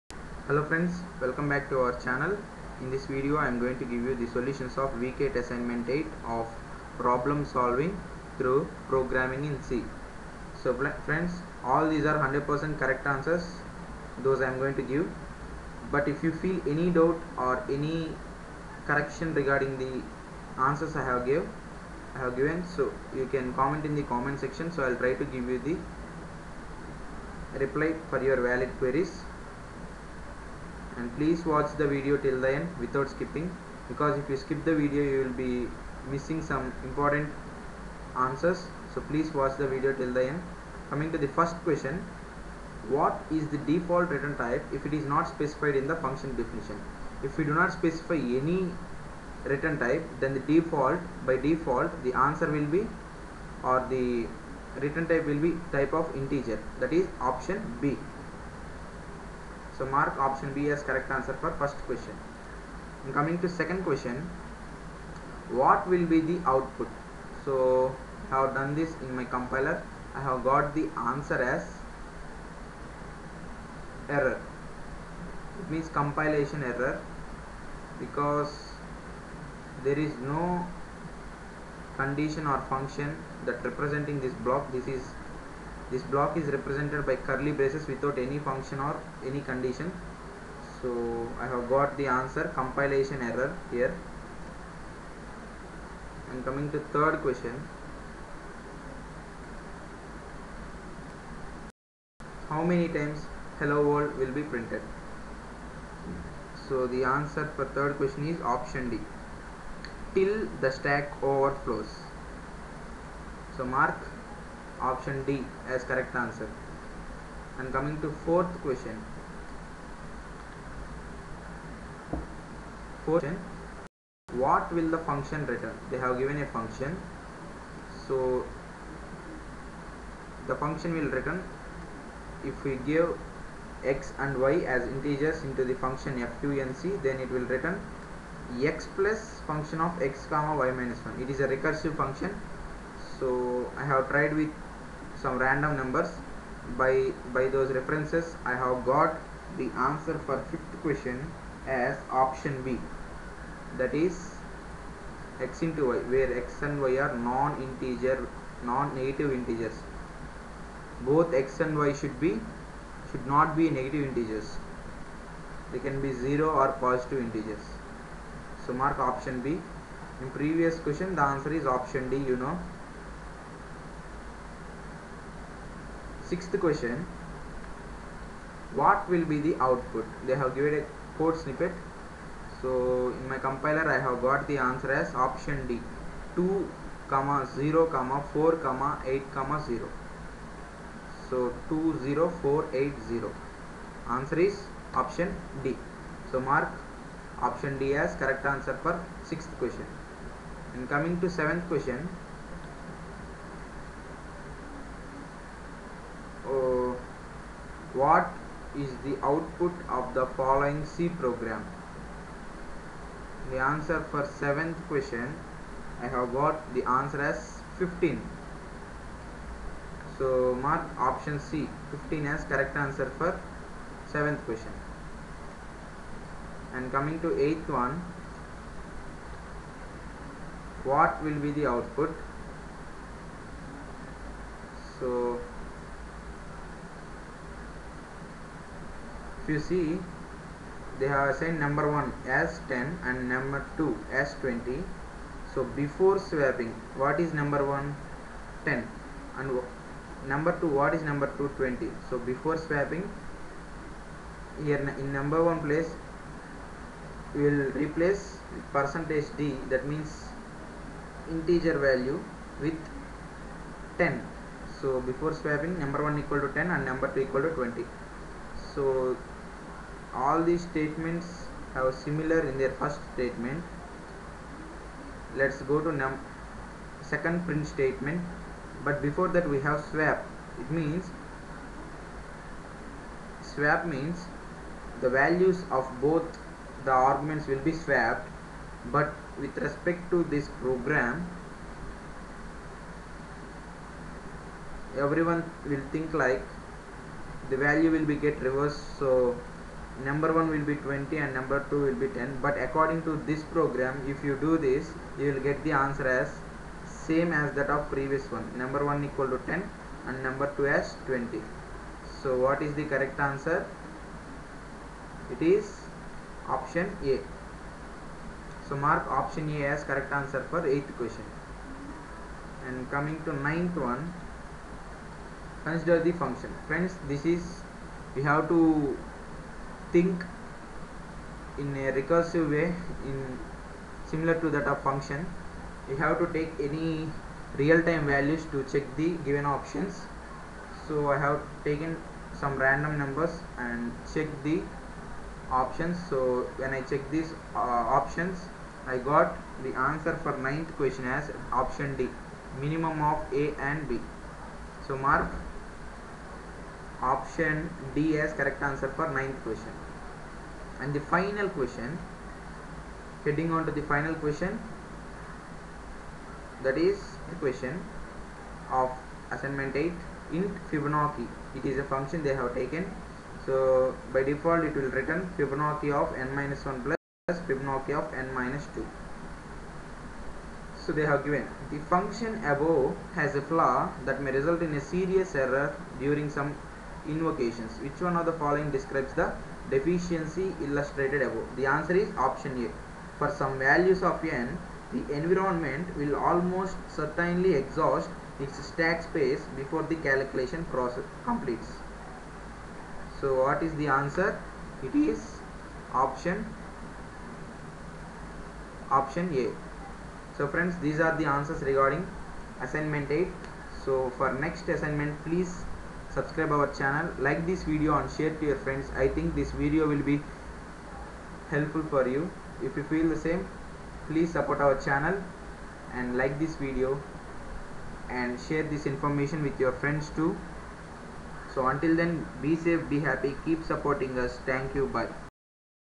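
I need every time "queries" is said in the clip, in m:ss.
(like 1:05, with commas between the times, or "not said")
0:28.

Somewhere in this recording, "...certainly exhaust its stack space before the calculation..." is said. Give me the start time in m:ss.
6:36.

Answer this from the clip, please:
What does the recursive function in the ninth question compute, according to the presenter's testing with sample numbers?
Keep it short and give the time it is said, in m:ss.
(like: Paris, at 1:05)
minimum of A and B, at 5:52.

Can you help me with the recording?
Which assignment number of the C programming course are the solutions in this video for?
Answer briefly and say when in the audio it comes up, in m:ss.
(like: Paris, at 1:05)
8, at 0:05.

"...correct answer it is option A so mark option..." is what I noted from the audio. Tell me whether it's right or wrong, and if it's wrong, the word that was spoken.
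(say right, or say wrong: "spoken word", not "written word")
right.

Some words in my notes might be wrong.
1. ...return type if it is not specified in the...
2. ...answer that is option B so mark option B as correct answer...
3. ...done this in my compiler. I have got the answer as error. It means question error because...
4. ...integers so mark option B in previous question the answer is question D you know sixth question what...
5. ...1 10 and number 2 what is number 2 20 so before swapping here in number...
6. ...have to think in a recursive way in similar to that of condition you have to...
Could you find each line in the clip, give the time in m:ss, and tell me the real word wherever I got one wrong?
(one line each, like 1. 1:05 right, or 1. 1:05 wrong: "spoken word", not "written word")
1. 0:44 right
2. 0:56 wrong: "integer", not "answer"
3. 1:08 wrong: "compilation", not "question"
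4. 2:47 wrong: "option", not "question"
5. 4:07 right
6. 5:28 wrong: "function", not "condition".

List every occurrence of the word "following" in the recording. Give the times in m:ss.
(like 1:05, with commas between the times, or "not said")
3:30, 6:28.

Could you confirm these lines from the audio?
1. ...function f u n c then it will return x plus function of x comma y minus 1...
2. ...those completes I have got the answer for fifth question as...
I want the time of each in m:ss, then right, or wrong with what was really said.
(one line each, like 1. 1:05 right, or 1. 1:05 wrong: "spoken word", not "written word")
1. 2:15 right
2. 2:27 wrong: "references", not "completes".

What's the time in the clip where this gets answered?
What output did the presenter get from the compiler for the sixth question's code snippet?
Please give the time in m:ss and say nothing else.
3:06.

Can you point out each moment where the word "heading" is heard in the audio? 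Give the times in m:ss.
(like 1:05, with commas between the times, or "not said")
6:03.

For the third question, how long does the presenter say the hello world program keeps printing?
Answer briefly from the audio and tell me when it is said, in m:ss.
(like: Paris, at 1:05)
till the stack overflows, at 1:50.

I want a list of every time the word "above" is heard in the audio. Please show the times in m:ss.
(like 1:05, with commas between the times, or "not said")
6:22, 6:31.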